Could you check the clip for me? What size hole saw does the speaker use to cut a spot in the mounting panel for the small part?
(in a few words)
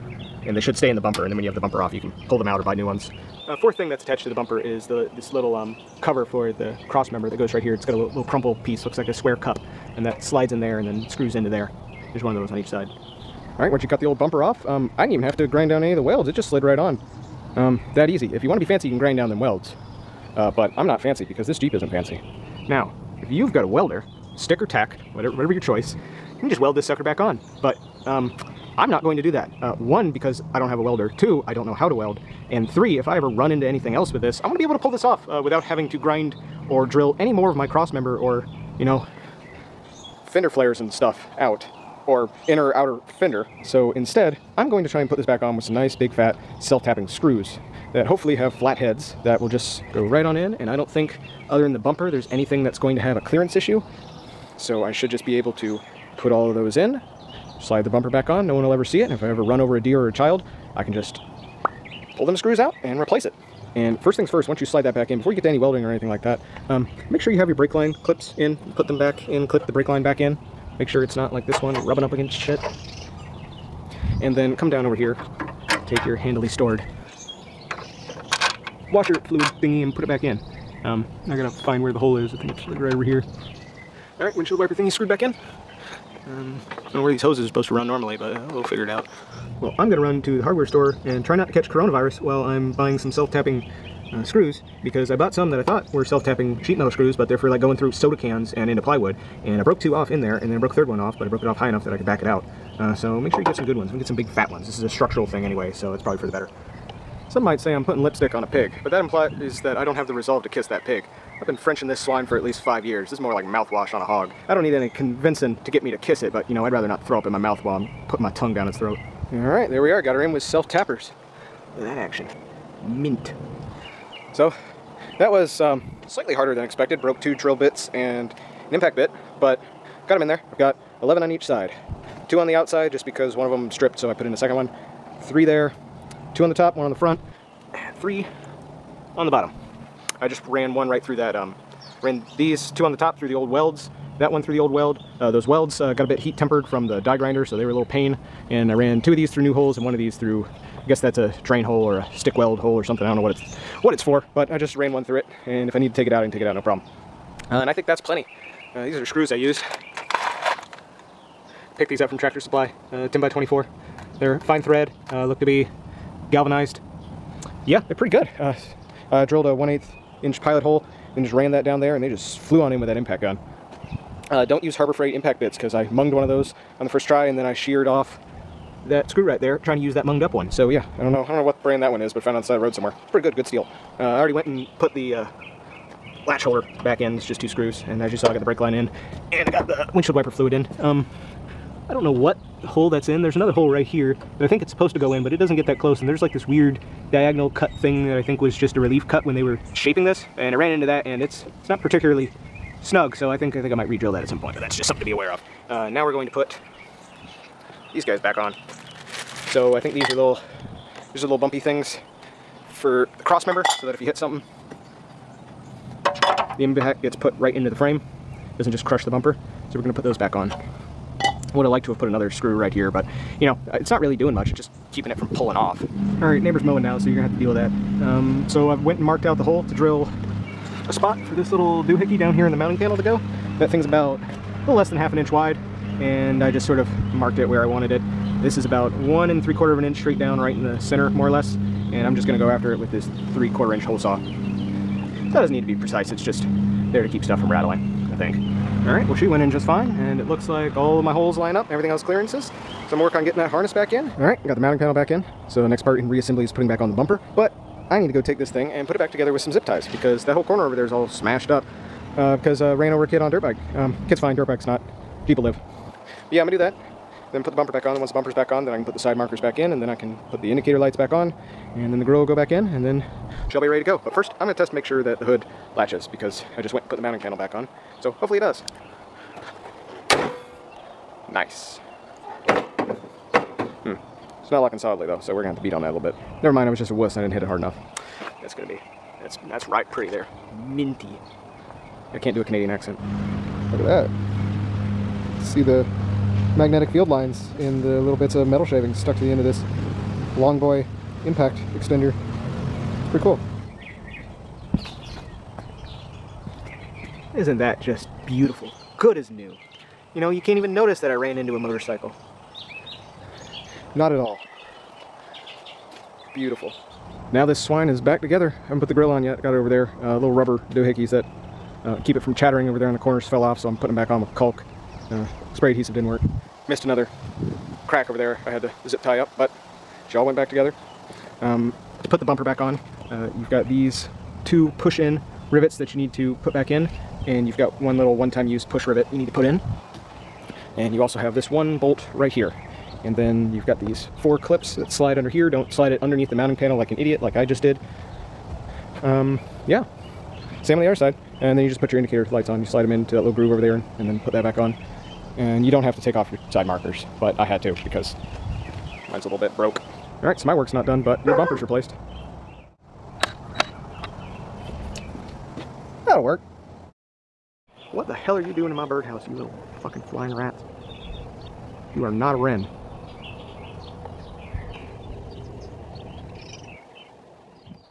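3/4 inch.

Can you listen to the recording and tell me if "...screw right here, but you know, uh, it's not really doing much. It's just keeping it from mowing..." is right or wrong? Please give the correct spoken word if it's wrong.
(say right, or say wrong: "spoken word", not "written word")
wrong: "pulling", not "mowing".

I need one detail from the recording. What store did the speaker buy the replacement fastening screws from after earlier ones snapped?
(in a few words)
Tractor Supply.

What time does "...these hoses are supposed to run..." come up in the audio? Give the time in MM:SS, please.
01:27.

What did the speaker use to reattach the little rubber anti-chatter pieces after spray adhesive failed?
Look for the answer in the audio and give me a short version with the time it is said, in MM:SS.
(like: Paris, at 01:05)
caulk, at 05:24.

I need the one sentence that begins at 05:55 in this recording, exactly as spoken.
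And you don't have to take off your side markers, but I had to because mine's a little bit broke.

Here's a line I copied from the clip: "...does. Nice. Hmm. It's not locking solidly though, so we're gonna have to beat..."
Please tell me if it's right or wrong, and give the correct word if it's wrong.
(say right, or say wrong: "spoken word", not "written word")
right.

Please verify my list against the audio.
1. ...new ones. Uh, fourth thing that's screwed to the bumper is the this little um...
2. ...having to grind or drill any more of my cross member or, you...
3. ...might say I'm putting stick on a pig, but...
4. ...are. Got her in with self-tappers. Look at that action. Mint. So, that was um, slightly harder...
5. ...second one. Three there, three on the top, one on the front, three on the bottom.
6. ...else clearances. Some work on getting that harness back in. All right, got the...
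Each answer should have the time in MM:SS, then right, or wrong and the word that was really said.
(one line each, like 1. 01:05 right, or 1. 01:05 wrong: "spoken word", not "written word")
1. 00:02 wrong: "attached", not "screwed"
2. 00:35 right
3. 01:47 wrong: "lipstick", not "stick"
4. 01:59 right
5. 02:14 wrong: "two", not "three"
6. 04:11 right.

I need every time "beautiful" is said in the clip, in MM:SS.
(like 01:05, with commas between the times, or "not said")
05:08, 05:16.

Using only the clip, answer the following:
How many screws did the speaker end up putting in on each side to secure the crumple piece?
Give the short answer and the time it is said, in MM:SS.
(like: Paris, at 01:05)
11, at 02:11.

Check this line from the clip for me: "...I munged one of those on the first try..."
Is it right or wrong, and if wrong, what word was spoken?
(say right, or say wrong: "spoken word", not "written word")
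right.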